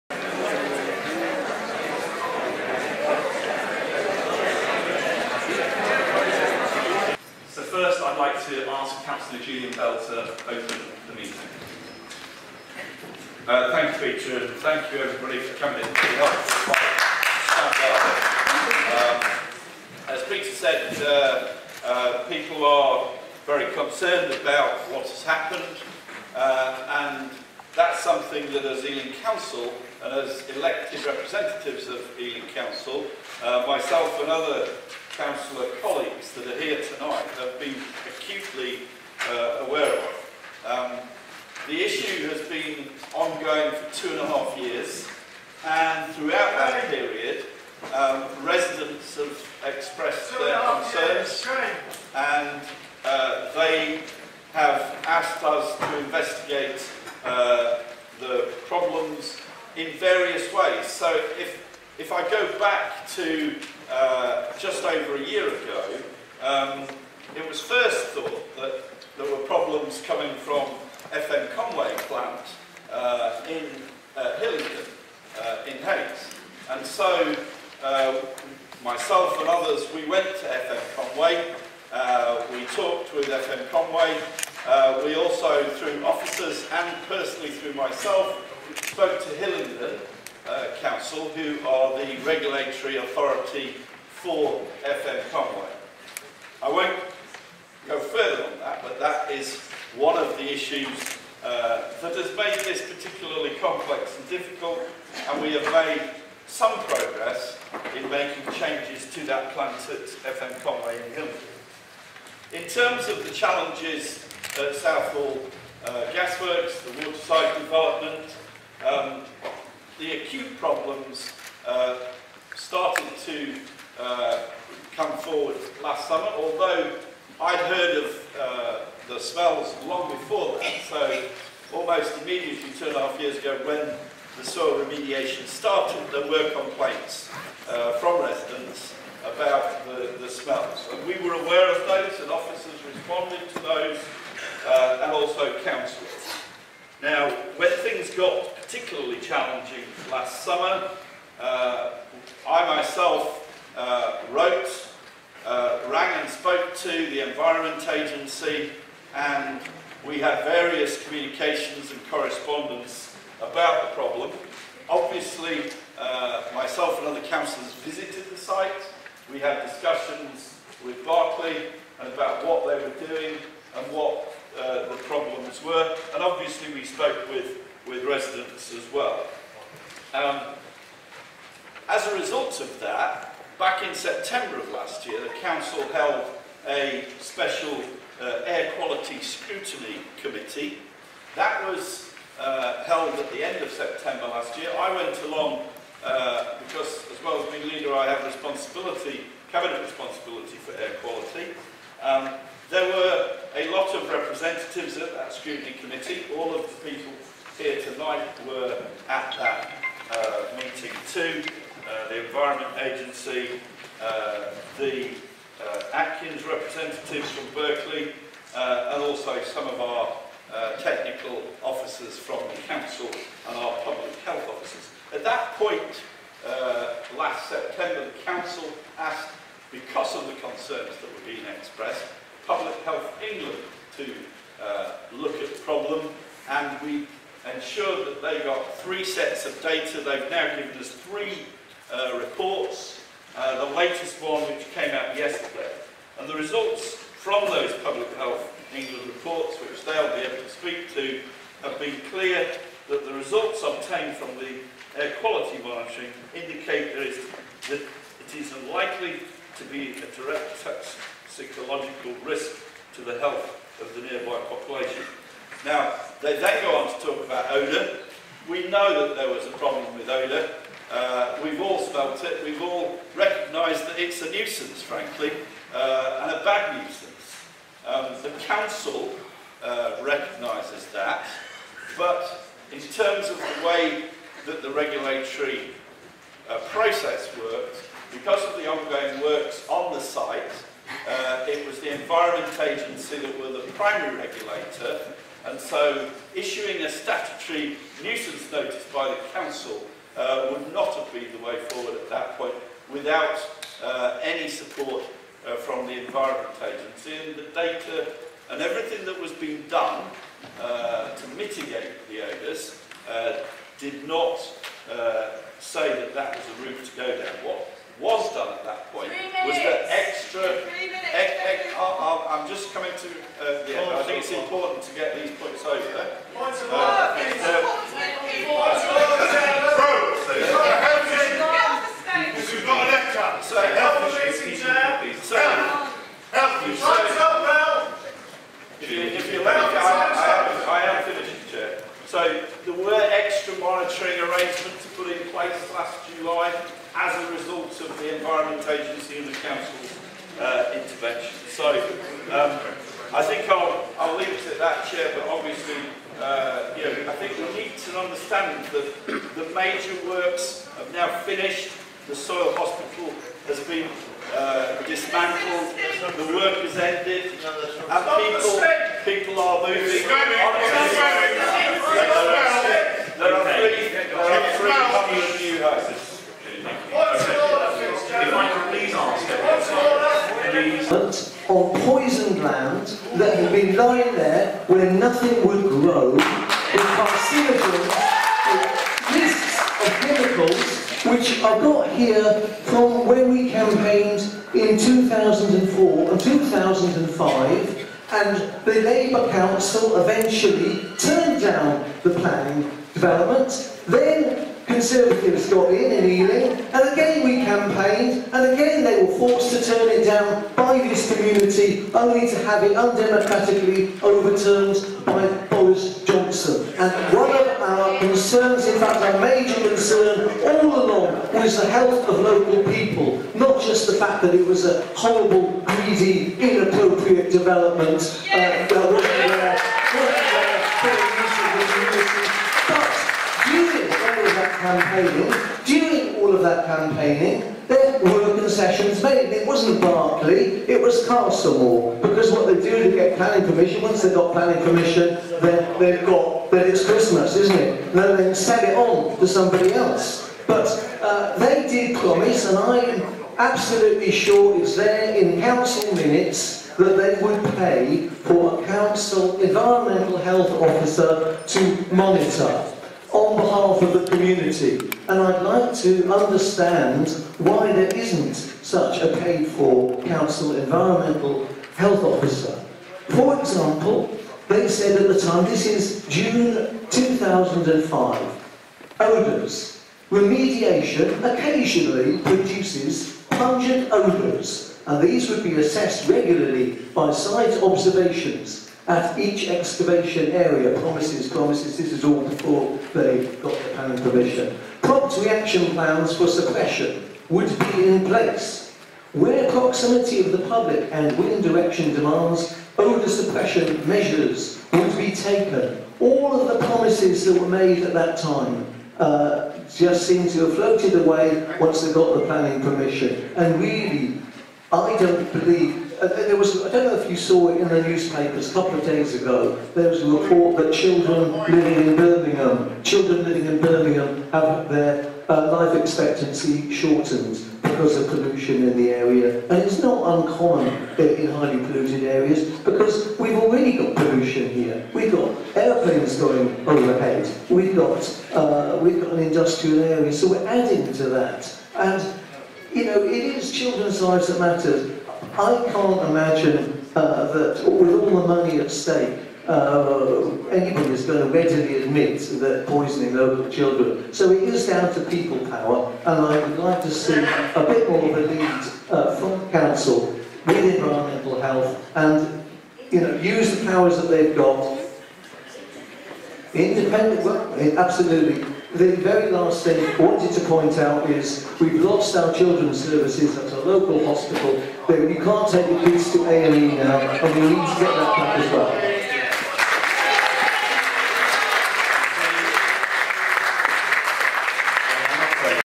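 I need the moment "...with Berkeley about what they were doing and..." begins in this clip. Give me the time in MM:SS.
02:50.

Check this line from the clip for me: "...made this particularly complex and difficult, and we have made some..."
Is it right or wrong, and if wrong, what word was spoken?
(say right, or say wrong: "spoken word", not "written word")
right.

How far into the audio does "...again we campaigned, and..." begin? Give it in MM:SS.
06:46.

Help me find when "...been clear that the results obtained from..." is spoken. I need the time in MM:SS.
04:11.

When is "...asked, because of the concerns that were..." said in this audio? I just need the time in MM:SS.
03:48.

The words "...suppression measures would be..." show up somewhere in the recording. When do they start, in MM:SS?
08:23.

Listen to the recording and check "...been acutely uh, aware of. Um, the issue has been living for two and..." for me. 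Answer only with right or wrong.
wrong.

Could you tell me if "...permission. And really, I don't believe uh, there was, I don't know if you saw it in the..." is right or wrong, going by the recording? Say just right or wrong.
right.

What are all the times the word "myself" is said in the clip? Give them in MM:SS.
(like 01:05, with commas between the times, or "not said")
00:33, 01:18, 01:27, 02:32, 02:46.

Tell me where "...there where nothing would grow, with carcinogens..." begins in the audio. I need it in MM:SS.
06:24.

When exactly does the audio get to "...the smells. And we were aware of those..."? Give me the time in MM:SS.
02:20.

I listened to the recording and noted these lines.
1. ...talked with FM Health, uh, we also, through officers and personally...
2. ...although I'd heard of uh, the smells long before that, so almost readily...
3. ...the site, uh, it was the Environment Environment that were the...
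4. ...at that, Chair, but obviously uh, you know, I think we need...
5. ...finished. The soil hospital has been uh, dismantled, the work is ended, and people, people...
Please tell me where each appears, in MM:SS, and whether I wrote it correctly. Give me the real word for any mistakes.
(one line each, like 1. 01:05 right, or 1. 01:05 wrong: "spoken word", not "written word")
1. 01:22 wrong: "Conway", not "Health"
2. 02:06 wrong: "immediately", not "readily"
3. 04:49 wrong: "Agency", not "Environment"
4. 05:54 right
5. 06:01 right.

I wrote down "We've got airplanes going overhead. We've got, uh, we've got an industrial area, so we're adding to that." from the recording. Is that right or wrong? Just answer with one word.
right.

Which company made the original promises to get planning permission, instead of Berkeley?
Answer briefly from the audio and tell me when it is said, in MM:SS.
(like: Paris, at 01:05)
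Castlemore, at 07:21.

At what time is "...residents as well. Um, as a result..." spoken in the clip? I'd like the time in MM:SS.
02:58.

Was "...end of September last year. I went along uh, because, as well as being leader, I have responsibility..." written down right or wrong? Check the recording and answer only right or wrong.
right.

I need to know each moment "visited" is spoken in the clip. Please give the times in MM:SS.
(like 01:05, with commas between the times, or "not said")
02:47.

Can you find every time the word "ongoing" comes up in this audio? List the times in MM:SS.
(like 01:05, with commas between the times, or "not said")
00:43, 04:48.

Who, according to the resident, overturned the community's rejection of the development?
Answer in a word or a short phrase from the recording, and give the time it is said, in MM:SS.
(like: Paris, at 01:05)
Boris Johnson, at 06:55.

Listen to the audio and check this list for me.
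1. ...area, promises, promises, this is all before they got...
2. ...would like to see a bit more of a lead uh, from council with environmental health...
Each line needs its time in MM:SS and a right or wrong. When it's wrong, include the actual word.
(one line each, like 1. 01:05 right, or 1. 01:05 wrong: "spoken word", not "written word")
1. 08:10 right
2. 09:16 right.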